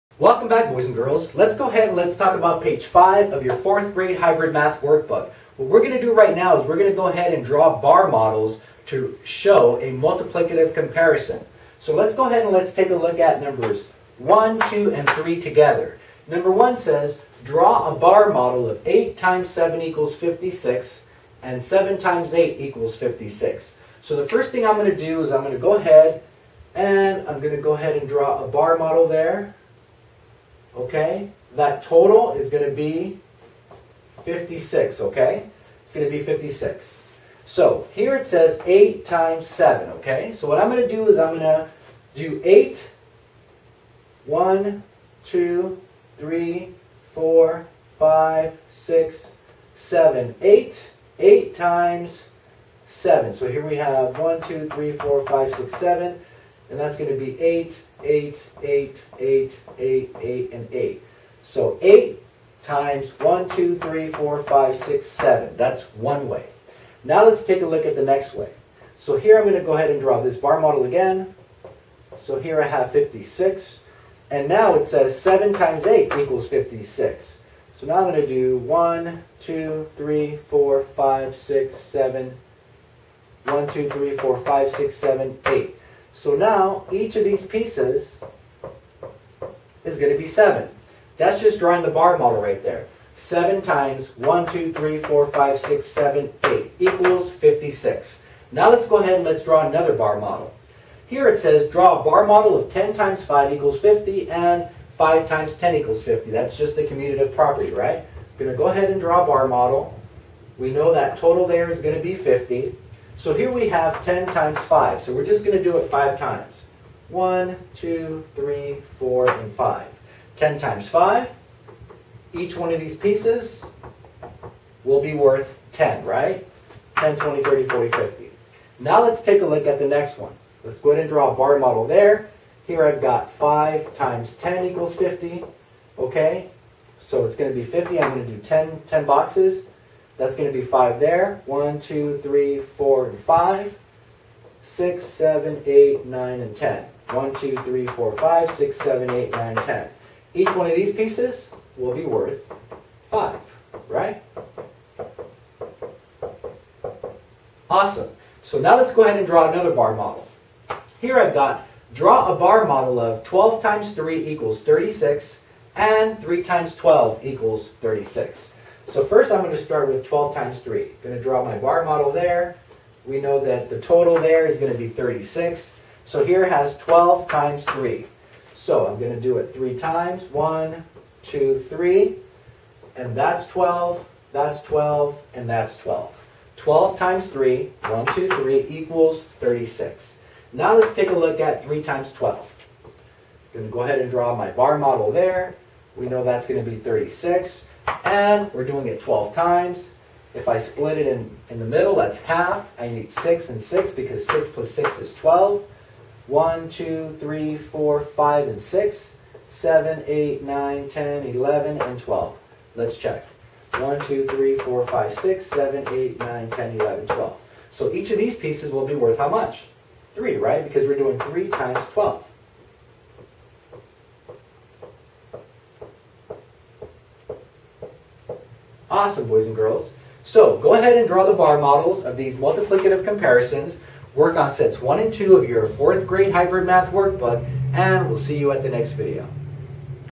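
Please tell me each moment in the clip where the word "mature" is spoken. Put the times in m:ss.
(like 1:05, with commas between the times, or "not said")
not said.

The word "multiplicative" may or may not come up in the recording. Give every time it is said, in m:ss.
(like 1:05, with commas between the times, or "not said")
0:09, 3:52.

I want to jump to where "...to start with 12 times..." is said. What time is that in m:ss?
2:49.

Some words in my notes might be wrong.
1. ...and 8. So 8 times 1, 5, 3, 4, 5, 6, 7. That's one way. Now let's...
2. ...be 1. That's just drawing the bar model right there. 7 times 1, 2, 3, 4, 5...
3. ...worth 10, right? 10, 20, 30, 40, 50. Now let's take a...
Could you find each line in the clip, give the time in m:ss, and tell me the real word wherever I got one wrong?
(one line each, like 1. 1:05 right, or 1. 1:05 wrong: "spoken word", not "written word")
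1. 1:00 wrong: "2", not "5"
2. 1:30 wrong: "7", not "1"
3. 2:05 right.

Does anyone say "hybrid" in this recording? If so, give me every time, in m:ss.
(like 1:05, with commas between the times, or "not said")
0:04, 3:56.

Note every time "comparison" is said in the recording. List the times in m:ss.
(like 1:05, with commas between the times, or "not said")
0:10, 3:53.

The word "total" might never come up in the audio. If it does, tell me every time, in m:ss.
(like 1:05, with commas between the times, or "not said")
0:31, 1:51, 2:53.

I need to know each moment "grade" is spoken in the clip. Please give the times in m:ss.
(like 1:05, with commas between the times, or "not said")
0:03, 3:56.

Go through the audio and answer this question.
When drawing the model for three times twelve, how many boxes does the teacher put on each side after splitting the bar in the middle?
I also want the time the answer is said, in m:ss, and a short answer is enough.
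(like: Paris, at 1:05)
6, at 3:22.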